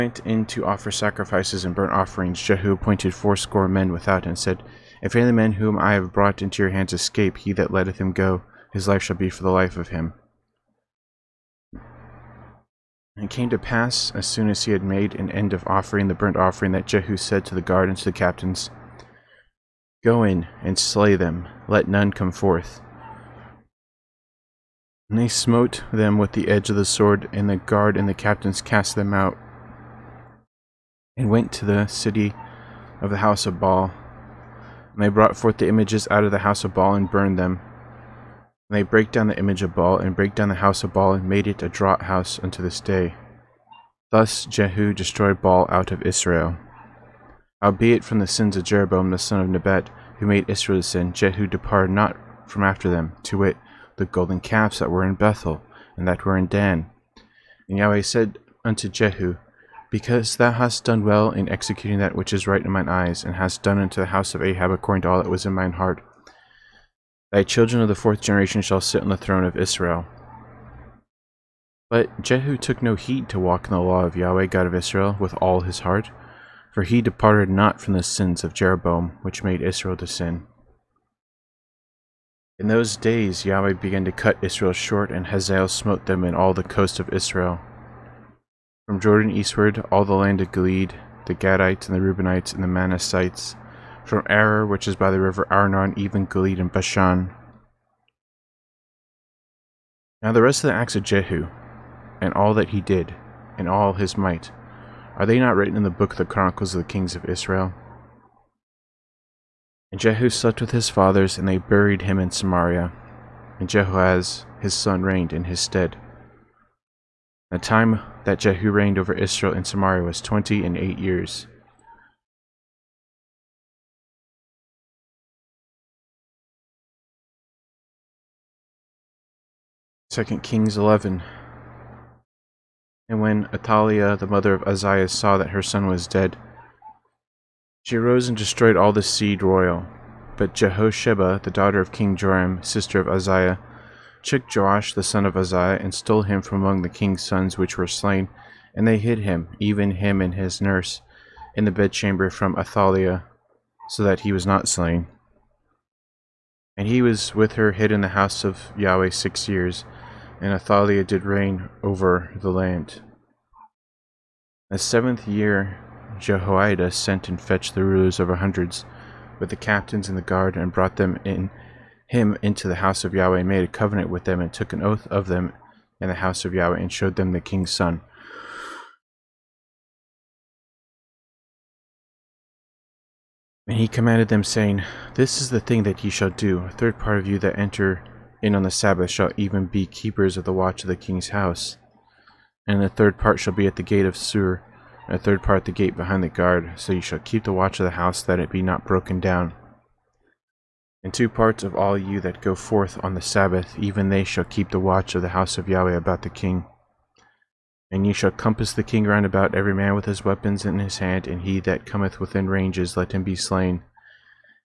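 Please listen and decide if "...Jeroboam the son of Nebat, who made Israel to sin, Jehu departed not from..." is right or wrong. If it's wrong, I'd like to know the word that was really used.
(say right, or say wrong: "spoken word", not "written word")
right.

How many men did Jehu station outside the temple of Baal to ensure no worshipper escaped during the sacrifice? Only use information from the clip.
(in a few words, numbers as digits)
80.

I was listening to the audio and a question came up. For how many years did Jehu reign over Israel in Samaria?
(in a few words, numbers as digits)
28.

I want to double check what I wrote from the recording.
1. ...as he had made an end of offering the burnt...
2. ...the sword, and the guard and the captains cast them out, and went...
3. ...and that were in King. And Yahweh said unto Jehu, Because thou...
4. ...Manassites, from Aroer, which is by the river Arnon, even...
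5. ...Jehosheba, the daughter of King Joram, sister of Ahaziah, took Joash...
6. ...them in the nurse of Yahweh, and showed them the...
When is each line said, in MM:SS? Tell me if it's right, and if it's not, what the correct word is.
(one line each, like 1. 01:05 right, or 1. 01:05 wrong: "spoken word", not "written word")
1. 00:14 right
2. 00:26 right
3. 00:55 wrong: "Dan", not "King"
4. 01:32 right
5. 02:20 right
6. 02:55 wrong: "house", not "nurse".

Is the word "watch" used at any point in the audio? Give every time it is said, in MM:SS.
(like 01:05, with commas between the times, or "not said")
03:10, 03:17, 03:24.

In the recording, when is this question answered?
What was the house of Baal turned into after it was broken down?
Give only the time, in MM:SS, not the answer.
00:41.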